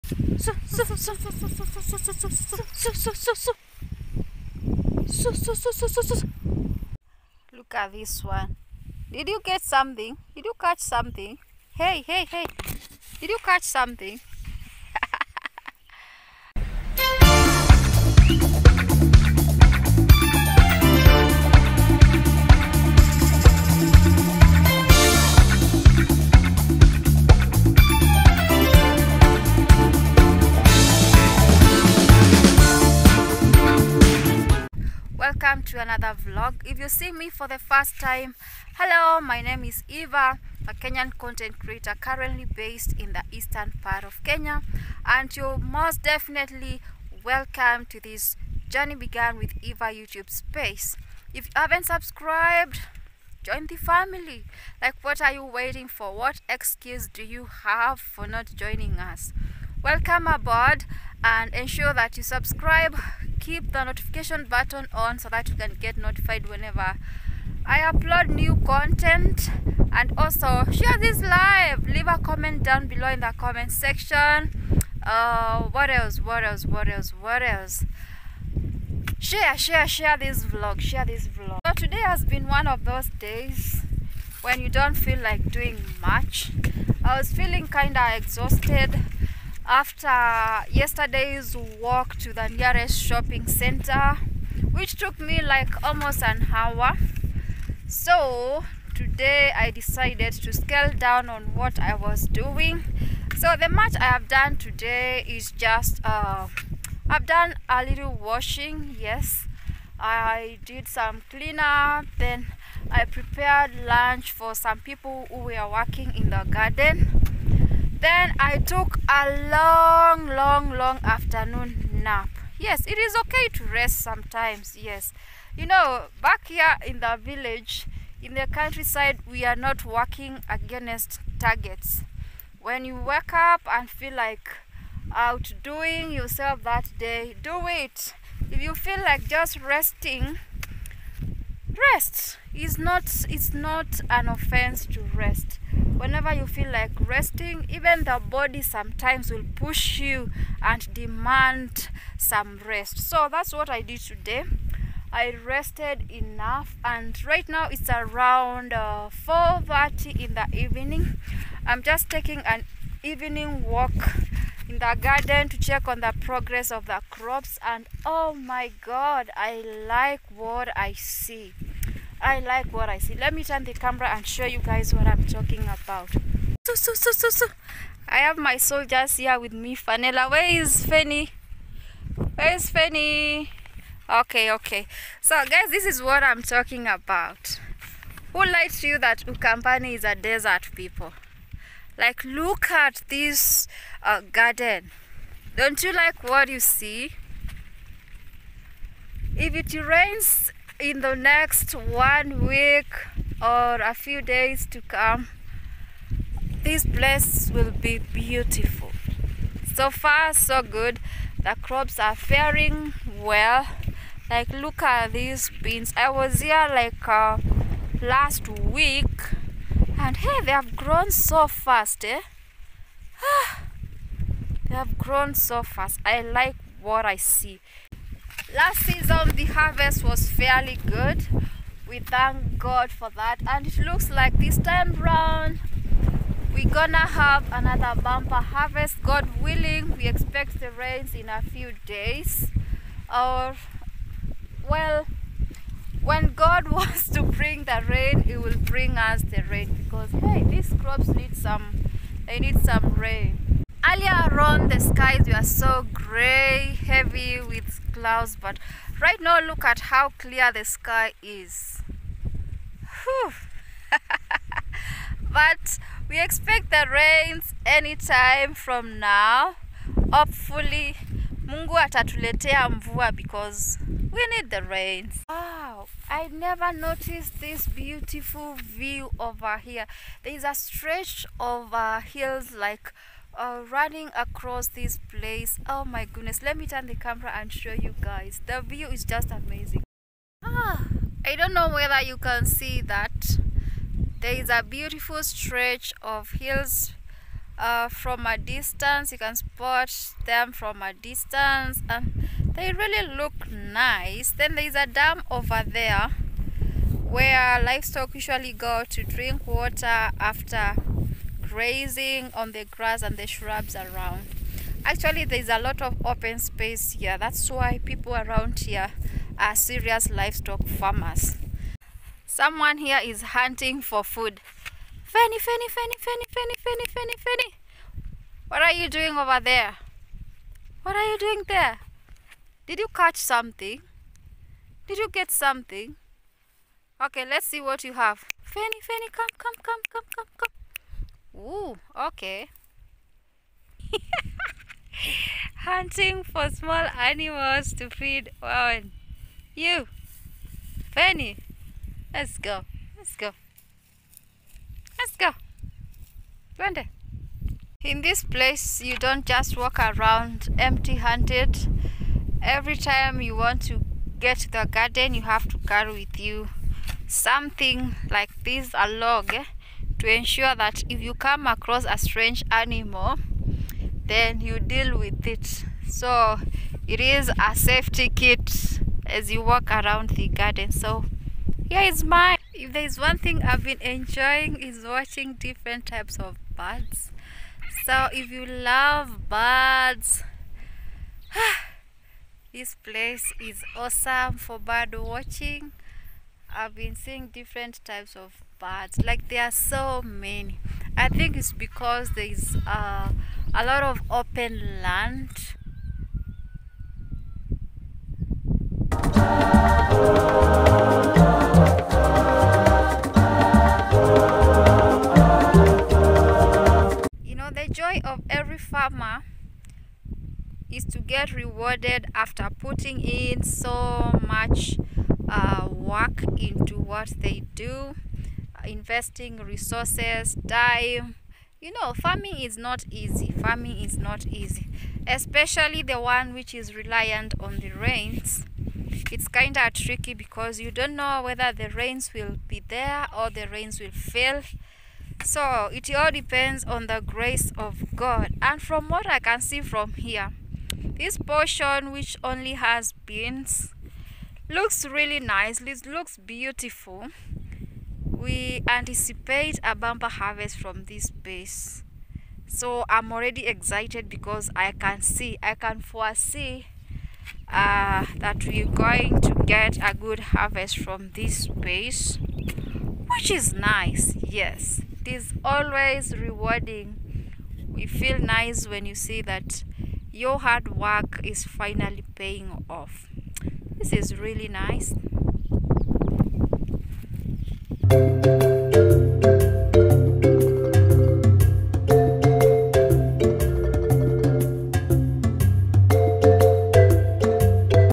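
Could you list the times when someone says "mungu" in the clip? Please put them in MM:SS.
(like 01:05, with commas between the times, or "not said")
04:31.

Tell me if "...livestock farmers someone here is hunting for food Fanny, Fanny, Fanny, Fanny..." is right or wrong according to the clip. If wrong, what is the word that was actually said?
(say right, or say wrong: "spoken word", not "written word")
right.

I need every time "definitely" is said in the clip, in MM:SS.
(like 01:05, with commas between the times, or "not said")
00:46.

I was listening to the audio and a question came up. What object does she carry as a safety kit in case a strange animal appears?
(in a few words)
A log.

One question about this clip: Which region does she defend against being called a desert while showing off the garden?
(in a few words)
Ukambani.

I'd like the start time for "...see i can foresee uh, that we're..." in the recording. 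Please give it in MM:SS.
07:45.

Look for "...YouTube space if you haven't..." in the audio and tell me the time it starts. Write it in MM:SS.
00:49.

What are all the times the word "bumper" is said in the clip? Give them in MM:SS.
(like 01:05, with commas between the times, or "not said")
03:58, 07:39.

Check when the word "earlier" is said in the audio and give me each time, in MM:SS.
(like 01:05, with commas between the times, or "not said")
04:13.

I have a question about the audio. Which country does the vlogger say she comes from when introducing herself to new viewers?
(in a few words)
Kenya.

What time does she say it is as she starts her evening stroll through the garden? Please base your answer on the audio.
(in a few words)
4:30.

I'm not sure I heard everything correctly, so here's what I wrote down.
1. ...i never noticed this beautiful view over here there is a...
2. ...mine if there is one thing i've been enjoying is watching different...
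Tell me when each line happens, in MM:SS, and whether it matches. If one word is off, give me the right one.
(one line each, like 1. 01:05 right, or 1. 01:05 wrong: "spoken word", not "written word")
1. 04:36 right
2. 06:22 right.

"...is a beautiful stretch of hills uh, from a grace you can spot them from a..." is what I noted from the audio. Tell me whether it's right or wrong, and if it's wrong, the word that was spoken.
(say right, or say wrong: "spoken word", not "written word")
wrong: "distance", not "grace".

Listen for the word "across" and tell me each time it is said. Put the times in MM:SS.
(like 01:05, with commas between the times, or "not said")
04:44, 06:11.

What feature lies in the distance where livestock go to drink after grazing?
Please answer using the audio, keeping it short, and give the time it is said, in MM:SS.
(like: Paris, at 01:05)
A dam, at 05:04.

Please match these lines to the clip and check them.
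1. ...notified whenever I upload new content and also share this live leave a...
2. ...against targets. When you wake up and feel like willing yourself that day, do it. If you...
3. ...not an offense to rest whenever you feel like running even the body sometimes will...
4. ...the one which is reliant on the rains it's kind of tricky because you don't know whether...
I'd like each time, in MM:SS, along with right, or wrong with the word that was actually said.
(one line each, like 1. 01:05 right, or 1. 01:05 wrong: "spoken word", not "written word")
1. 01:05 right
2. 02:10 wrong: "outdoing", not "willing"
3. 02:23 wrong: "resting", not "running"
4. 07:15 right.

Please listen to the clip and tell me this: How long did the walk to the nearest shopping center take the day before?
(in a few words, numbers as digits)
almost an hour.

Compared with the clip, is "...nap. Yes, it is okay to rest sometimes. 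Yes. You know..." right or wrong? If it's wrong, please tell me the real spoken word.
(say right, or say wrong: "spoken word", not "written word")
right.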